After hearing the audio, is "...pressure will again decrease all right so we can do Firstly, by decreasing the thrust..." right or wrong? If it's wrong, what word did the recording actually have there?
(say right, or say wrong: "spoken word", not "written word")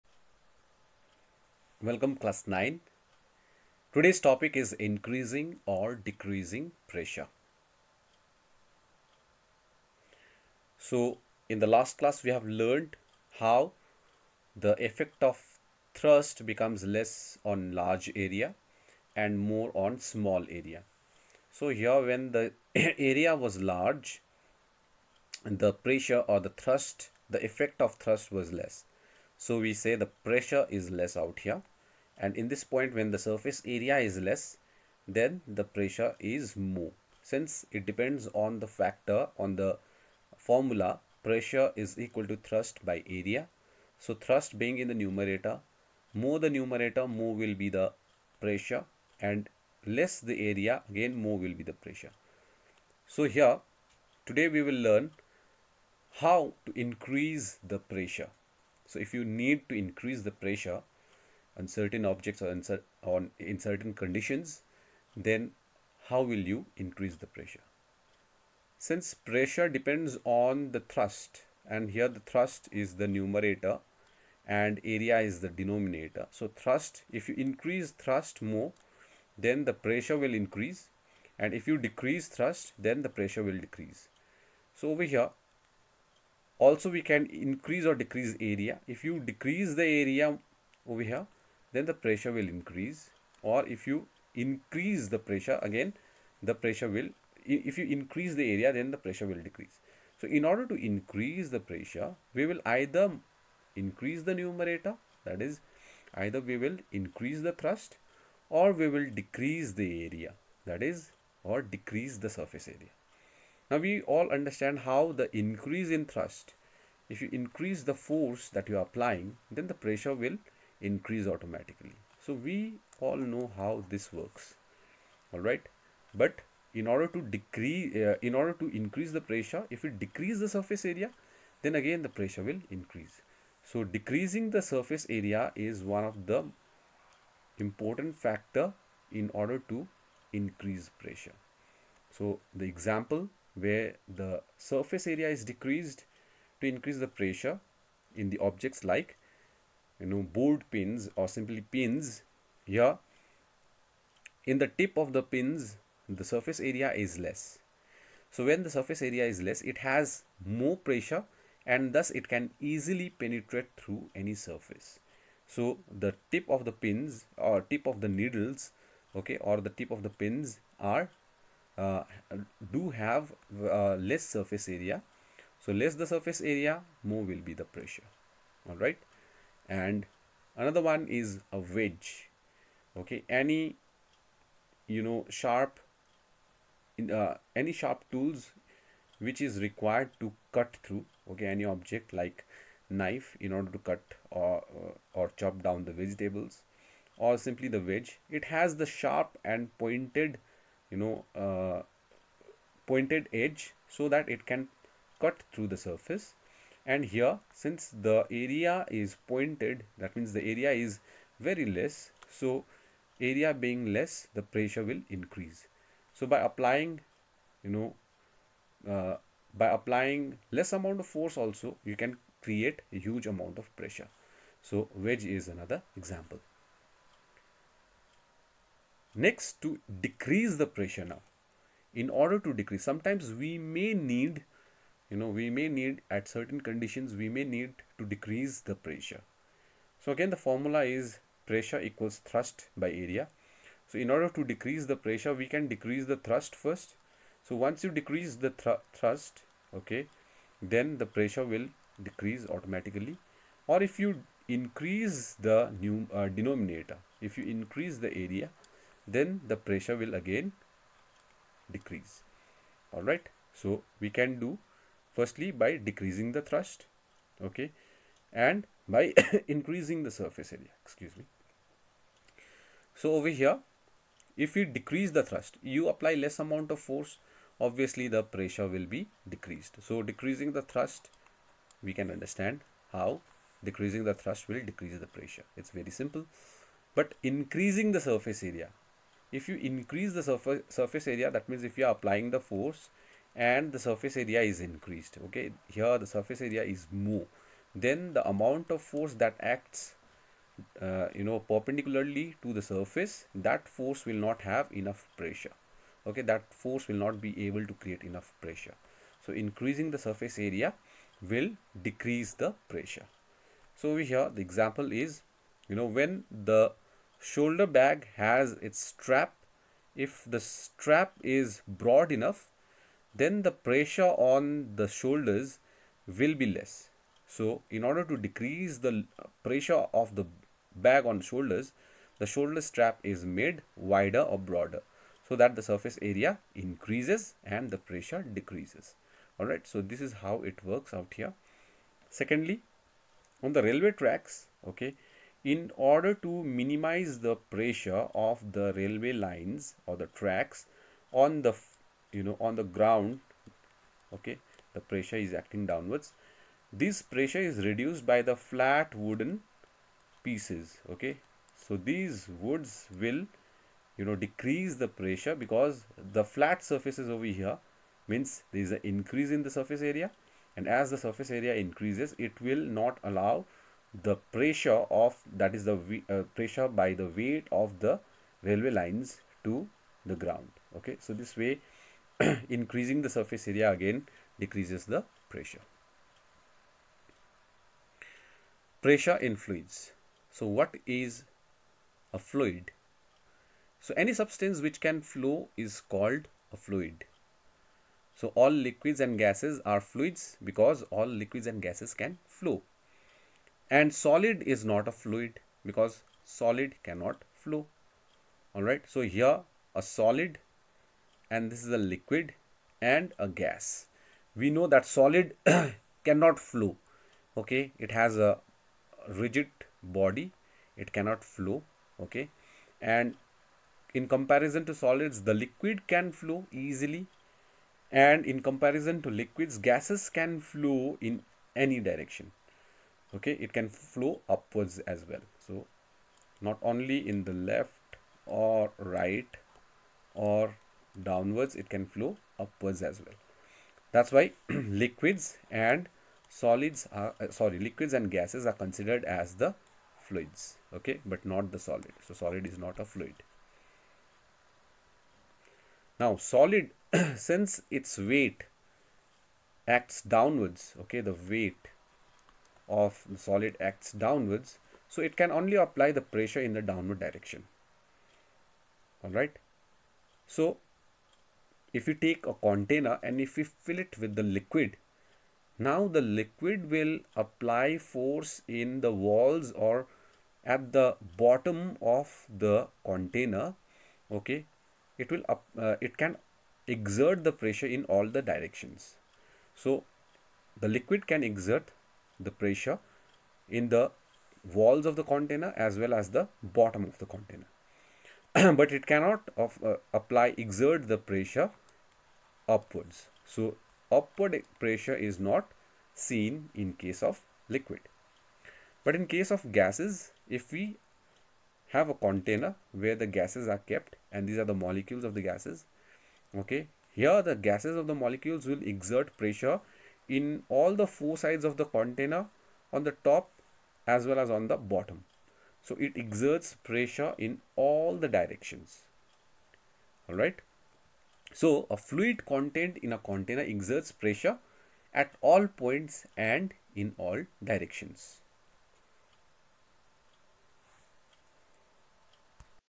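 right.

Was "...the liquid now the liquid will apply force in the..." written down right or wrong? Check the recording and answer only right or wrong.
right.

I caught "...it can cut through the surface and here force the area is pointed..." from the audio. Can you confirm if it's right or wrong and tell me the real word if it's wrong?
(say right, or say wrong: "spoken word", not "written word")
wrong: "since", not "force".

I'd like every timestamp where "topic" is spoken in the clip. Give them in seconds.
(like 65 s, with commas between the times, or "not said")
4 s.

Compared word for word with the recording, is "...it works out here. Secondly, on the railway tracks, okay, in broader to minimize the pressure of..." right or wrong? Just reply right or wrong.
wrong.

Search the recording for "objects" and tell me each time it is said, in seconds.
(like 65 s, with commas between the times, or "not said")
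62 s, 148 s, 191 s.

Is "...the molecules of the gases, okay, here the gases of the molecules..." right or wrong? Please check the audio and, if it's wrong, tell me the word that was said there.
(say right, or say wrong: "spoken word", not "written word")
right.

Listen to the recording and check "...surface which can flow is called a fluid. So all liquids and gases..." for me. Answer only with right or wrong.
wrong.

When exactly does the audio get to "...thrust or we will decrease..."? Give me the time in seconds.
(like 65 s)
107 s.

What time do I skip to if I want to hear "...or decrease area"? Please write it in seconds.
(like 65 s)
87 s.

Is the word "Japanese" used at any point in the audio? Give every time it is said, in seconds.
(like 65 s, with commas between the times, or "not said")
not said.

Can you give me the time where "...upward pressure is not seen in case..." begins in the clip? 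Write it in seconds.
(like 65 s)
503 s.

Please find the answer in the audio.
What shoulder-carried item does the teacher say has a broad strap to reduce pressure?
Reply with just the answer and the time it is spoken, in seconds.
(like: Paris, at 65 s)
Shoulder bag, at 317 s.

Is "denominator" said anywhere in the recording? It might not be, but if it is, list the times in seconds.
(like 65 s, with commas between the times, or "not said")
75 s, 256 s.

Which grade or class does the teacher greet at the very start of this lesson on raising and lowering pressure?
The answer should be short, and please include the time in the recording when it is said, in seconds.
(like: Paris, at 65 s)
Class 9, at 2 s.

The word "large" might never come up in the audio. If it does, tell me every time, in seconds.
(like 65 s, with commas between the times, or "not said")
17 s, 23 s.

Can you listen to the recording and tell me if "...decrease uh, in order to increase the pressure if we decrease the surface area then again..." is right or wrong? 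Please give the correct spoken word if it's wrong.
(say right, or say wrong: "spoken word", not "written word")
right.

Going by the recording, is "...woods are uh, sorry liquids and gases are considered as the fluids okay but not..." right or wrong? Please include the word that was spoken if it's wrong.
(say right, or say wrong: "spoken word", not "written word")
wrong: "solids", not "woods".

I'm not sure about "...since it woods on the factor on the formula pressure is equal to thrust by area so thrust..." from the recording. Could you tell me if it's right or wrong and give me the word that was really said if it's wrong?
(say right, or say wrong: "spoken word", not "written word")
wrong: "depends", not "woods".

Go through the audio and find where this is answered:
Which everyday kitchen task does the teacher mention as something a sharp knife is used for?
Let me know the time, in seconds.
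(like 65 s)
195 s.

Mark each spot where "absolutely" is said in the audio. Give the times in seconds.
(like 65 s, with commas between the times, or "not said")
not said.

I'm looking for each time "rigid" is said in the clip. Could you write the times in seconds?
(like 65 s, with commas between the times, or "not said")
419 s.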